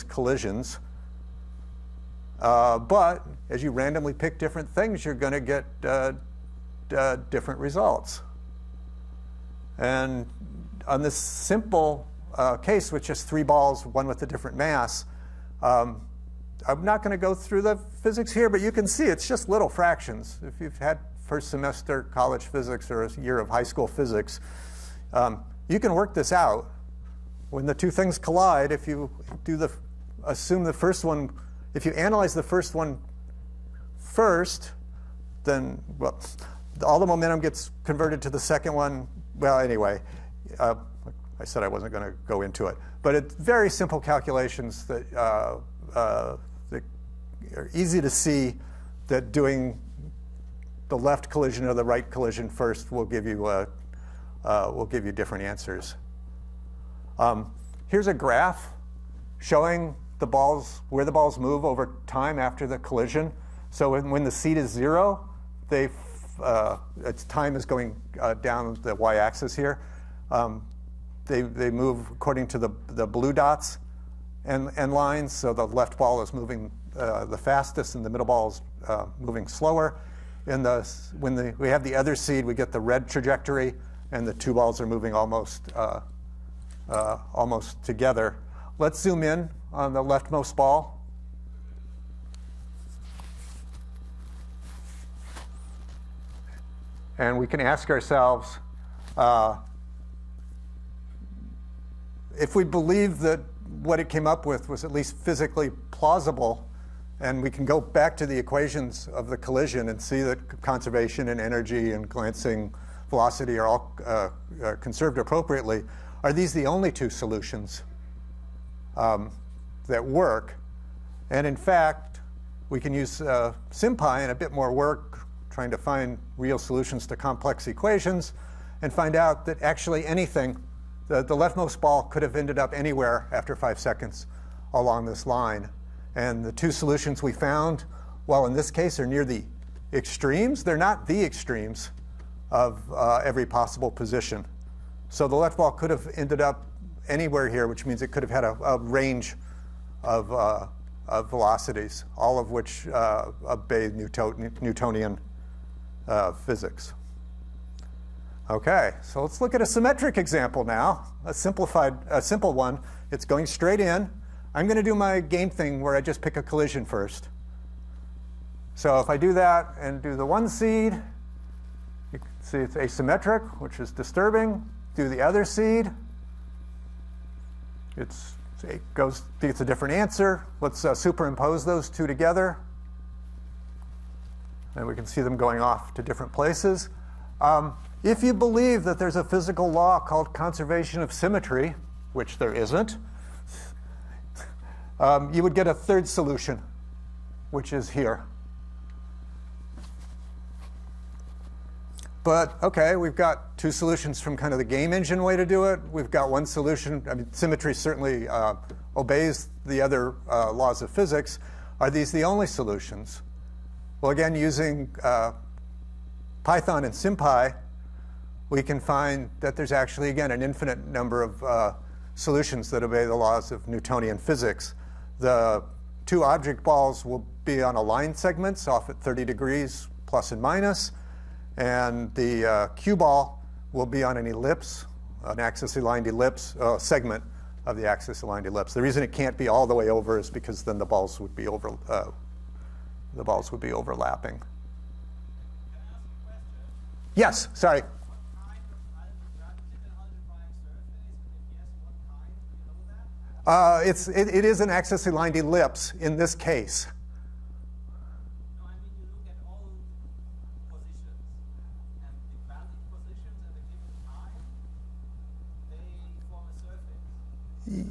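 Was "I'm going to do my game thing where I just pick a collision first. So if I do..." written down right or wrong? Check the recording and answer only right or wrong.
right.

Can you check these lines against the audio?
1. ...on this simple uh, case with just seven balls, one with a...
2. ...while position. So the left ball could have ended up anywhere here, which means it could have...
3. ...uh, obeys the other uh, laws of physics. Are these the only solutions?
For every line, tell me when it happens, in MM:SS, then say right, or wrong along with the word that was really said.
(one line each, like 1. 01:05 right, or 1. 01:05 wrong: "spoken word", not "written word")
1. 00:10 wrong: "three", not "seven"
2. 02:23 wrong: "possible", not "while"
3. 03:28 right.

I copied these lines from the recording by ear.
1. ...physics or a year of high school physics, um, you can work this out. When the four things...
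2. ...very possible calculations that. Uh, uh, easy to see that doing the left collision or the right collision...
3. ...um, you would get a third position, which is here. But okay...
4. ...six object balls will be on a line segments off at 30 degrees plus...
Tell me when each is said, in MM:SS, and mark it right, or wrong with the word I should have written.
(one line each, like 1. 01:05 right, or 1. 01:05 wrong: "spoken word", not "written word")
1. 00:22 wrong: "two", not "four"
2. 00:43 wrong: "simple", not "possible"
3. 03:14 wrong: "solution", not "position"
4. 03:46 wrong: "two", not "six".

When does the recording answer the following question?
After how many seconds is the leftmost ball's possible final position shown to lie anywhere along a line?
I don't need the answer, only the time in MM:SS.
02:13.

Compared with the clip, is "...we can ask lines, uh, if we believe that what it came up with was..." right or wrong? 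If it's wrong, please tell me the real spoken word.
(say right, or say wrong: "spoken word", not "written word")
wrong: "ourselves", not "lines".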